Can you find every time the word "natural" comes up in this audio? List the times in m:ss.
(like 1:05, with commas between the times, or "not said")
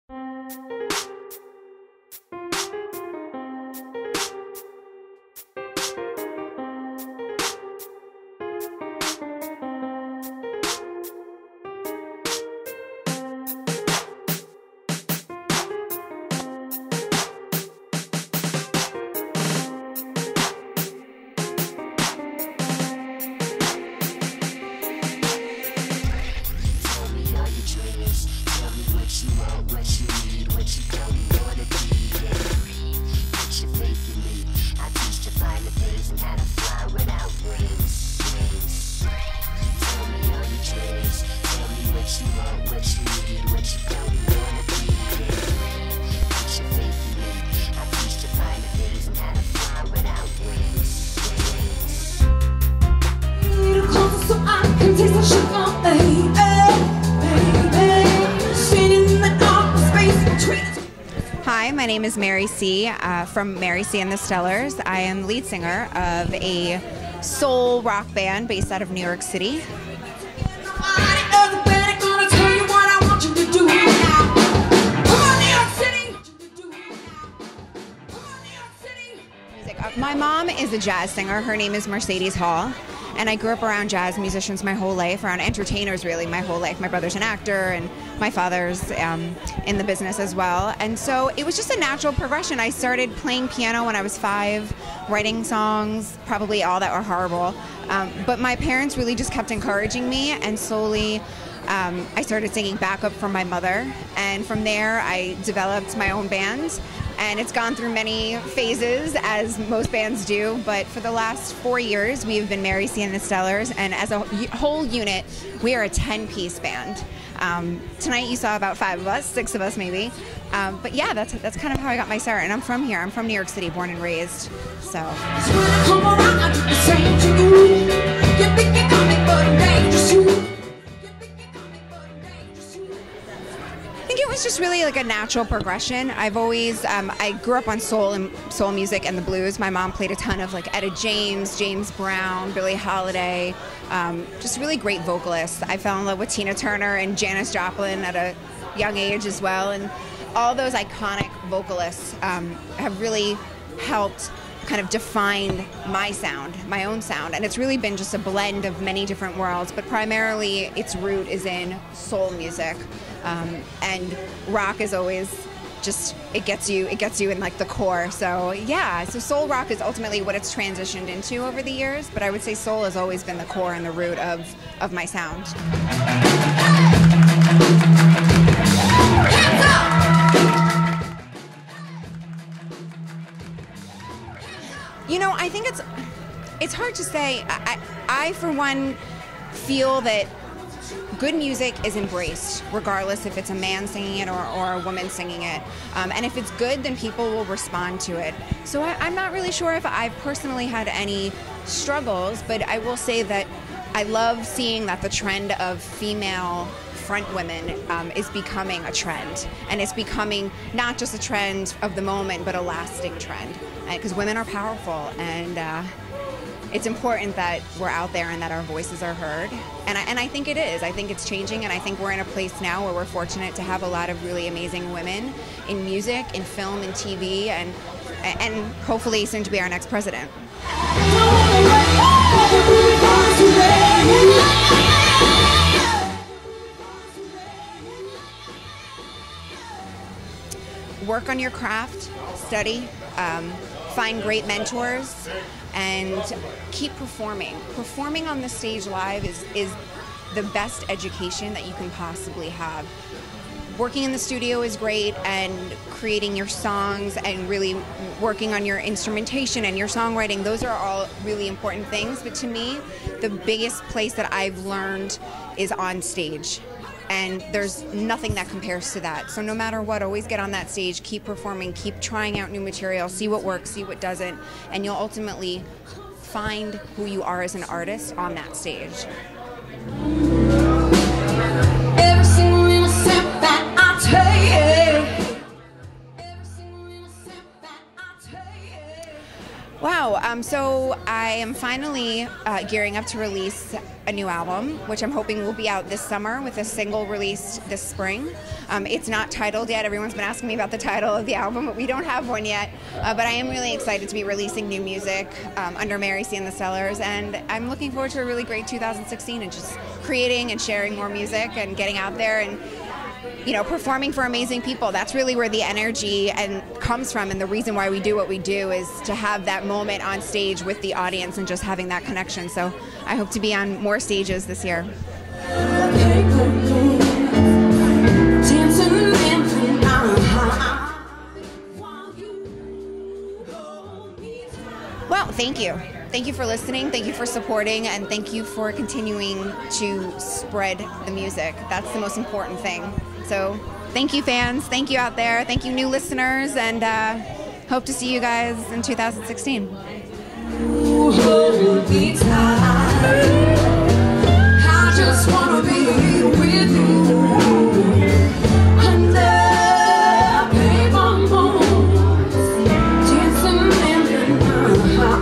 1:31, 2:15.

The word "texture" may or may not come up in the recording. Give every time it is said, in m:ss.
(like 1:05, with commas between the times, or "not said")
not said.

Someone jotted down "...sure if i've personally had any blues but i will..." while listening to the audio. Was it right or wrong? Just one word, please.
wrong.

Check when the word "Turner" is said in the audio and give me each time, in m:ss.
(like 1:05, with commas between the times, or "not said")
2:26.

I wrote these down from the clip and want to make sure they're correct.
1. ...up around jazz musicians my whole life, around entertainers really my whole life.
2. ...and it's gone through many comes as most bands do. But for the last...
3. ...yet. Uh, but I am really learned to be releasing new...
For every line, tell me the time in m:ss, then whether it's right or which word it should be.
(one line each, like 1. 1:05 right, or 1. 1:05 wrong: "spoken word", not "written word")
1. 1:23 right
2. 1:47 wrong: "phases", not "comes"
3. 5:02 wrong: "excited", not "learned".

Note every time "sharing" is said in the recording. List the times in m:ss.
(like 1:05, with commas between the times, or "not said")
5:10.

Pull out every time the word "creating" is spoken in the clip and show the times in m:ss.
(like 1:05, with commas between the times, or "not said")
4:15, 5:10.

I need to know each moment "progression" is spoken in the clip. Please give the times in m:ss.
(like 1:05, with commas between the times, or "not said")
1:32, 2:15.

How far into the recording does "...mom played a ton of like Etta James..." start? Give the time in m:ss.
2:19.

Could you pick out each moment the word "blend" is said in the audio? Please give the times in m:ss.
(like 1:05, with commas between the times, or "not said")
2:38.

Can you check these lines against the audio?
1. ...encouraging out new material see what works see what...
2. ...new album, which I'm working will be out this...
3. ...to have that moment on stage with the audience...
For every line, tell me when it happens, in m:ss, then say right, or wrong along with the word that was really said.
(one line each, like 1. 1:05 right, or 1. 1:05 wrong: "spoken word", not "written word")
1. 4:31 wrong: "trying", not "encouraging"
2. 4:54 wrong: "hoping", not "working"
3. 5:19 right.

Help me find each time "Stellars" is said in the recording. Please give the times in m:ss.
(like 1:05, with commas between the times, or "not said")
1:04, 1:53, 5:06.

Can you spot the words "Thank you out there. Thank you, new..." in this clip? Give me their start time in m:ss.
5:44.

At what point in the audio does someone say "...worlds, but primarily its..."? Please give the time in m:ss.
2:39.